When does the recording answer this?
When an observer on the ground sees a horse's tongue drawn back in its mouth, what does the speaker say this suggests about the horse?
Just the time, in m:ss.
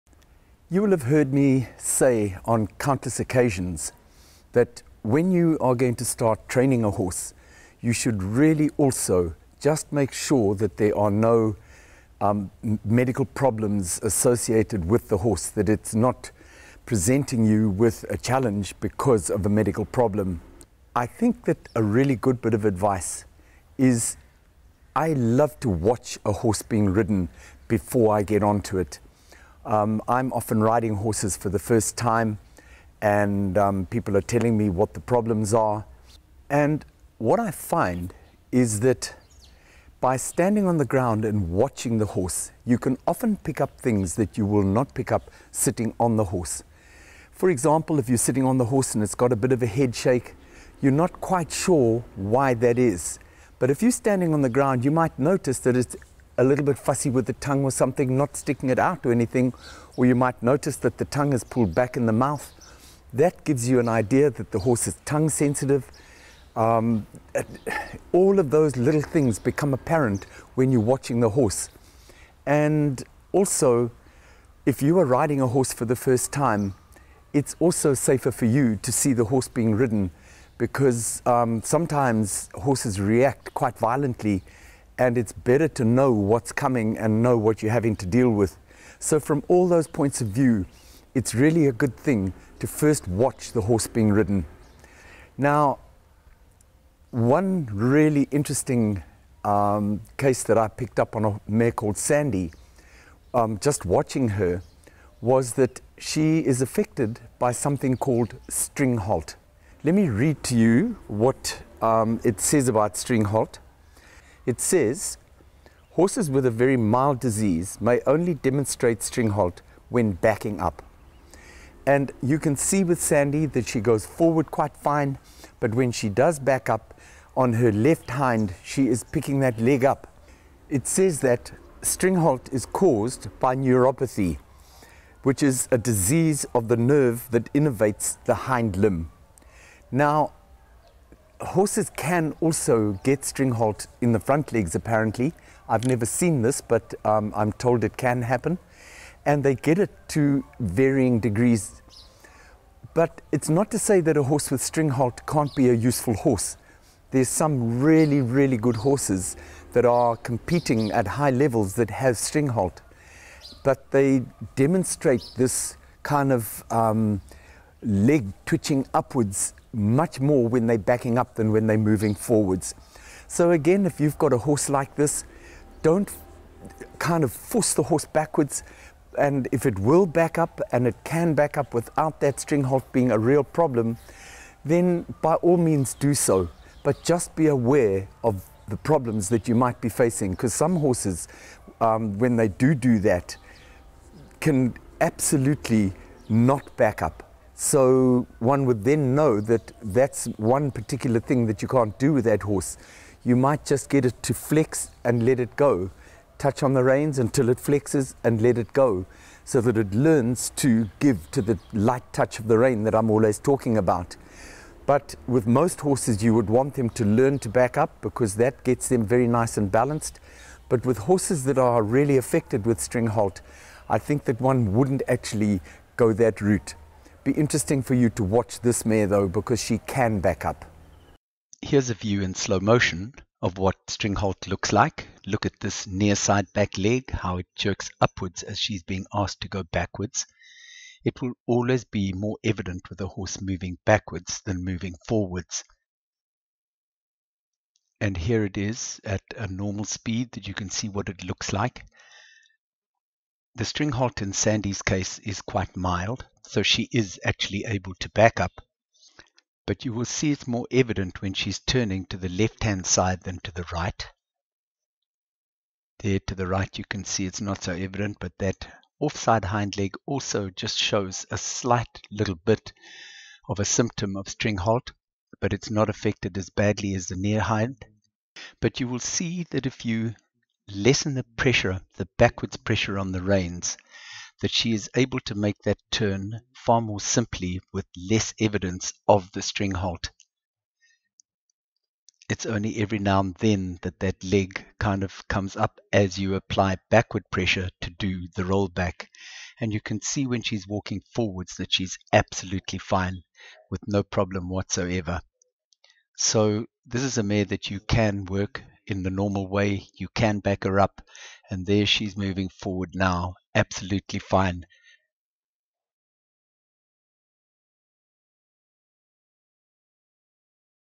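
1:05.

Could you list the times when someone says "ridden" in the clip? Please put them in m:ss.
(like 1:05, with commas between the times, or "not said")
0:26, 1:19, 1:34.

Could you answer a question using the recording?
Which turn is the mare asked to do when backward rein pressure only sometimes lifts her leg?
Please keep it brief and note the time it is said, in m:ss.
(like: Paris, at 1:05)
Rollback, at 4:58.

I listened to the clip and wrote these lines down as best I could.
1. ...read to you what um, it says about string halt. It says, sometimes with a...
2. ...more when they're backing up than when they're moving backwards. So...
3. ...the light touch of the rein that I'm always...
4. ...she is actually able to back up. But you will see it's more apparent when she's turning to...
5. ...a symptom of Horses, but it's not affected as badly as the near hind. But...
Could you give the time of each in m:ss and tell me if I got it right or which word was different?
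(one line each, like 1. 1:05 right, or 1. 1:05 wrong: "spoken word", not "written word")
1. 1:50 wrong: "horses", not "sometimes"
2. 2:50 wrong: "forwards", not "backwards"
3. 3:31 right
4. 4:16 wrong: "evident", not "apparent"
5. 4:33 wrong: "Stringhalt", not "Horses".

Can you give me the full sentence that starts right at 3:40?
But with horses that are really affected with string halt, I think that one wouldn't actually go that route.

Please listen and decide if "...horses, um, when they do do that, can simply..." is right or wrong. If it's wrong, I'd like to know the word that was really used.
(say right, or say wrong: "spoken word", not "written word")
wrong: "absolutely", not "simply".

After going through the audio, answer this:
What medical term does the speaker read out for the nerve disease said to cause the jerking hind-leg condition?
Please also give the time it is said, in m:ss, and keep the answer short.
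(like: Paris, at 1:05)
Neuropathy, at 2:13.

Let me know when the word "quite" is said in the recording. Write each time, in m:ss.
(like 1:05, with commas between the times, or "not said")
0:51, 1:23, 2:04, 4:15.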